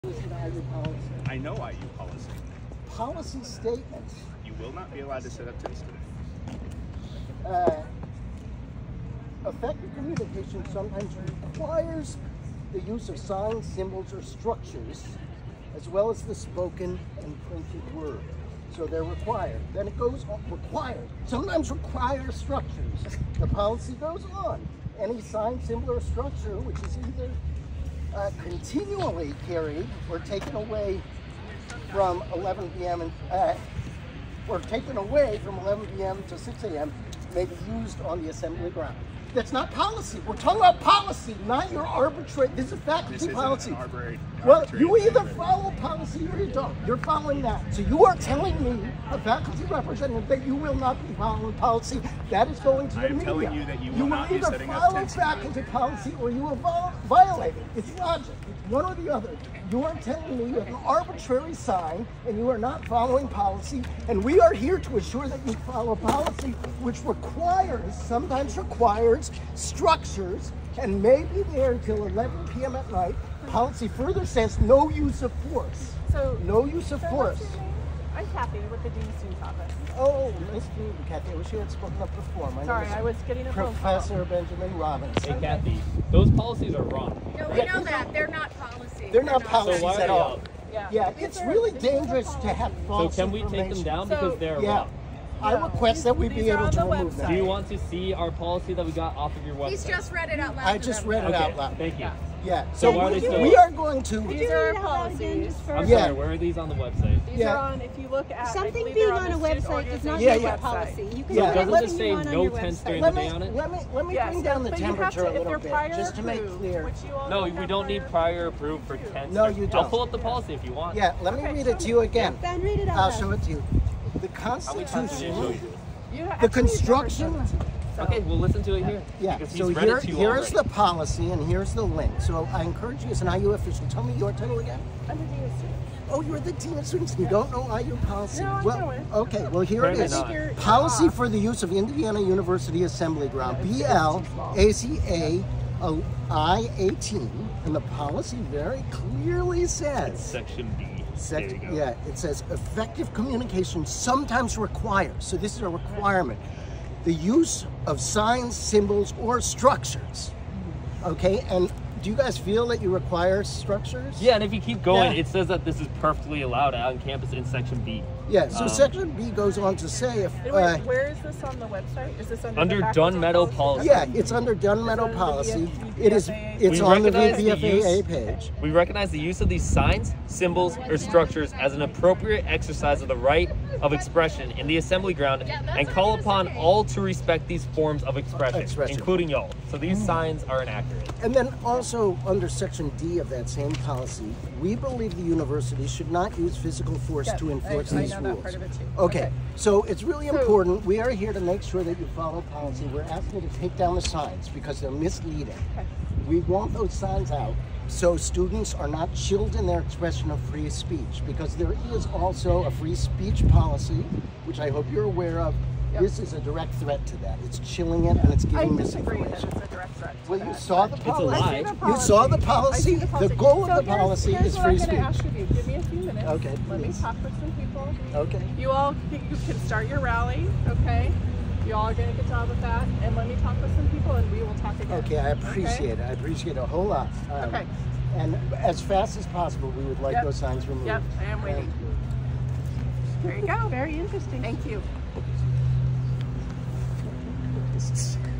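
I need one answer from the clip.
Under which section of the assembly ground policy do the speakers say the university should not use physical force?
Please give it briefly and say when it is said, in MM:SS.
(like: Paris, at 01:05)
Section D, at 03:12.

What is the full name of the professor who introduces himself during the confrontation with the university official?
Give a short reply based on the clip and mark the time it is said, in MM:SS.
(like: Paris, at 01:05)
Benjamin Robbins, at 01:24.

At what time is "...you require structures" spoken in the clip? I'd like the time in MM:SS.
02:42.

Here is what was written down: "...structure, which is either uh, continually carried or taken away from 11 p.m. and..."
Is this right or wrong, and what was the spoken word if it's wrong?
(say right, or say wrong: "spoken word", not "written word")
right.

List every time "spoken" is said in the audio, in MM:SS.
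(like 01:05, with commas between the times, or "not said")
00:16, 01:21.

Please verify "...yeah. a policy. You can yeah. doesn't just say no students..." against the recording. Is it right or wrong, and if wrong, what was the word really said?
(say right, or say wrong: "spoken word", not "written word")
wrong: "tents", not "students".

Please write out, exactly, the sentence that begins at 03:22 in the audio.
We're asking you to take down the signs because they're misleading.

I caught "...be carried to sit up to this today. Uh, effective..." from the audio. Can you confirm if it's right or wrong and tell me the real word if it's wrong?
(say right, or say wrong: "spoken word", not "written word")
wrong: "allowed", not "carried".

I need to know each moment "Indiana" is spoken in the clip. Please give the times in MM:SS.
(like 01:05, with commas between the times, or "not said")
02:21.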